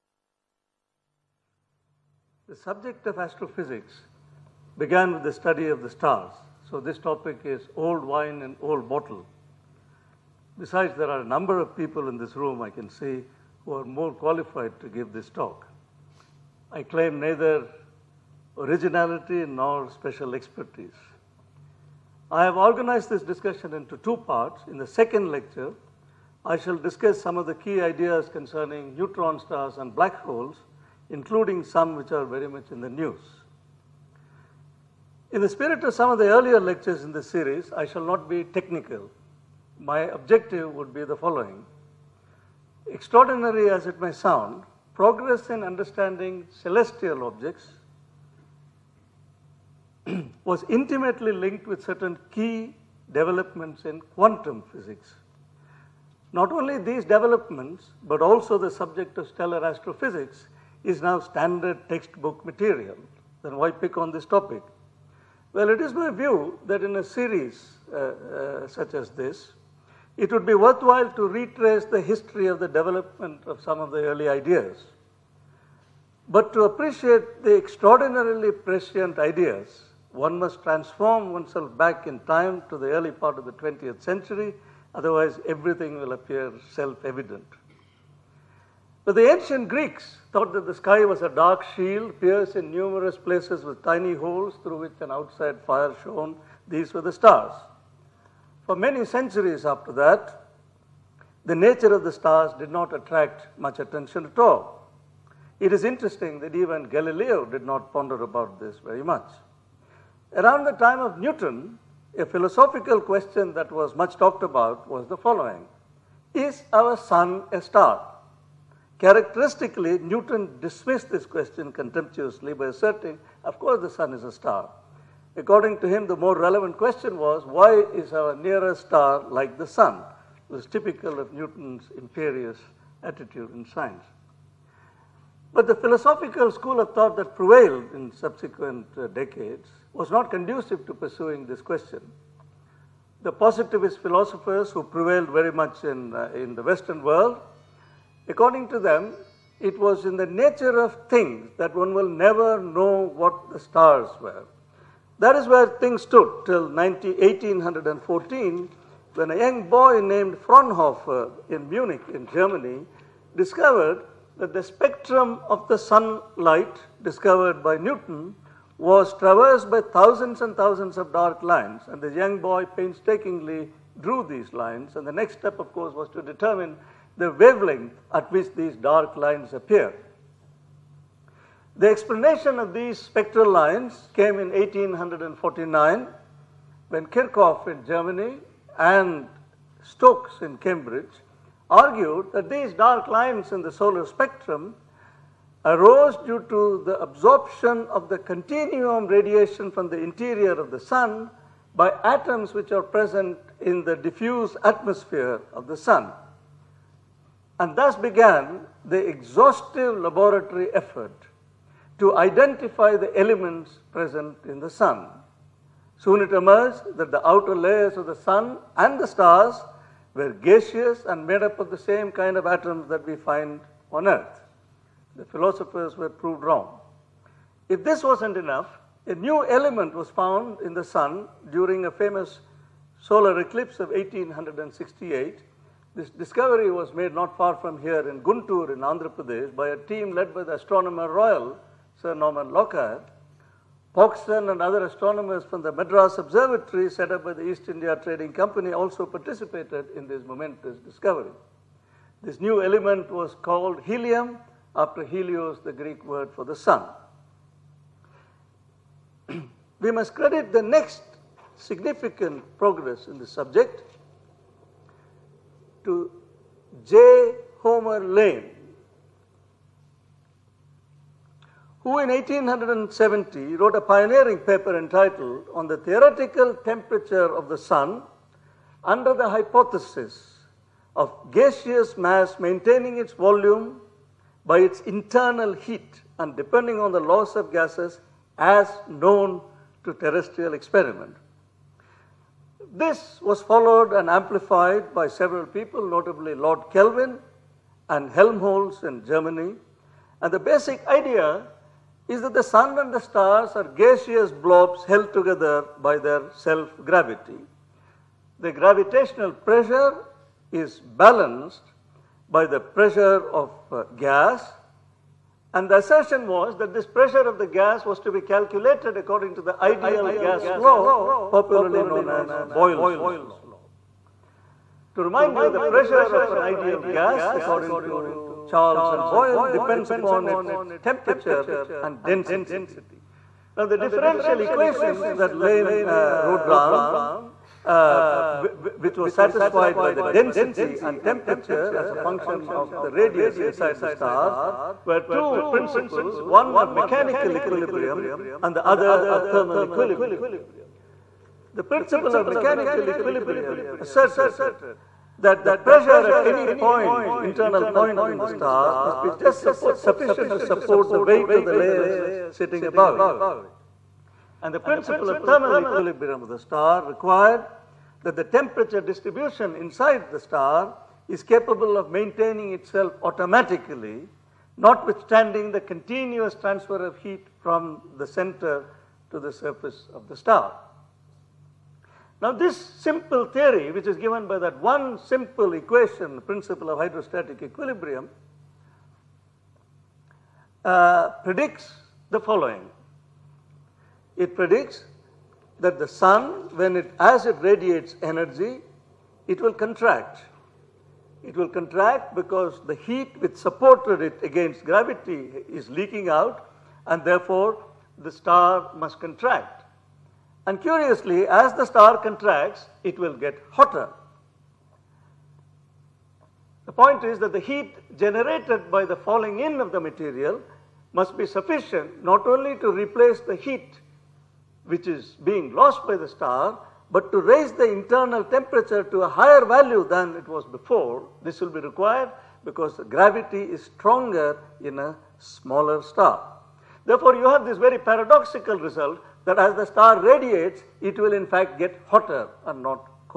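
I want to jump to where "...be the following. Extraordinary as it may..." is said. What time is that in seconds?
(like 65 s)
40 s.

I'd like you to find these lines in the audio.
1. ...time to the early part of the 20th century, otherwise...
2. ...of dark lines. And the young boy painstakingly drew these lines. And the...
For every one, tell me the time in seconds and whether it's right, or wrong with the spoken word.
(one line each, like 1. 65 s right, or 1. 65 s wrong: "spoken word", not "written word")
1. 82 s right
2. 170 s right.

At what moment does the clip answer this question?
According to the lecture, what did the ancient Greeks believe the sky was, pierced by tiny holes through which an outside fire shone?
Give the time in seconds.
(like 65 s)
91 s.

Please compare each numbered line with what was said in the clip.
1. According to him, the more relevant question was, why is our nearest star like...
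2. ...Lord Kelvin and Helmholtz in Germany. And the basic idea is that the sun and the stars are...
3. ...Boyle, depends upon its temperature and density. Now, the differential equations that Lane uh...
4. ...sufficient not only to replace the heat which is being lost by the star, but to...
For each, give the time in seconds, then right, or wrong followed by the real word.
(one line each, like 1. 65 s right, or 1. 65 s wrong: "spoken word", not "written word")
1. 125 s right
2. 296 s right
3. 329 s right
4. 421 s right.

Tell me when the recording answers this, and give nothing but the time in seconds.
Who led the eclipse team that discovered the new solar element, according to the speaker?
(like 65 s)
242 s.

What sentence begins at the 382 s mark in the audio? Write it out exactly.
Now this simple theory, which is given by that one simple equation, the principle of hydrostatic equilibrium, uh, predicts the following.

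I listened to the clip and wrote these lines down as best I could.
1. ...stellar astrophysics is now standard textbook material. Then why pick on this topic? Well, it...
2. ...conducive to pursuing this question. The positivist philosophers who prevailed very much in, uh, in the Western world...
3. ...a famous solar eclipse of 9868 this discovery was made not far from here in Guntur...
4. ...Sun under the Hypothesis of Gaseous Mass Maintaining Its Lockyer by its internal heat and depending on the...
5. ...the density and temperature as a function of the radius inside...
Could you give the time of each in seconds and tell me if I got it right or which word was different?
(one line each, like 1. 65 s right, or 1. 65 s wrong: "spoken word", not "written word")
1. 59 s right
2. 140 s right
3. 231 s wrong: "1868", not "9868"
4. 277 s wrong: "Volume", not "Lockyer"
5. 339 s right.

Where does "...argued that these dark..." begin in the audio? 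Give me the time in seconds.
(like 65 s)
191 s.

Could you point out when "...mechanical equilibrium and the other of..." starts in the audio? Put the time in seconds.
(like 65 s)
346 s.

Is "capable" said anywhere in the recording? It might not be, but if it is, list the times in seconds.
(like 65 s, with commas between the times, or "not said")
371 s.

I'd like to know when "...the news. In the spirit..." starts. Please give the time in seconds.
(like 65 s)
32 s.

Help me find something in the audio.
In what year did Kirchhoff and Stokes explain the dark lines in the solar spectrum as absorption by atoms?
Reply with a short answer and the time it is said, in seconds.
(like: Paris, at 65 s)
1849, at 184 s.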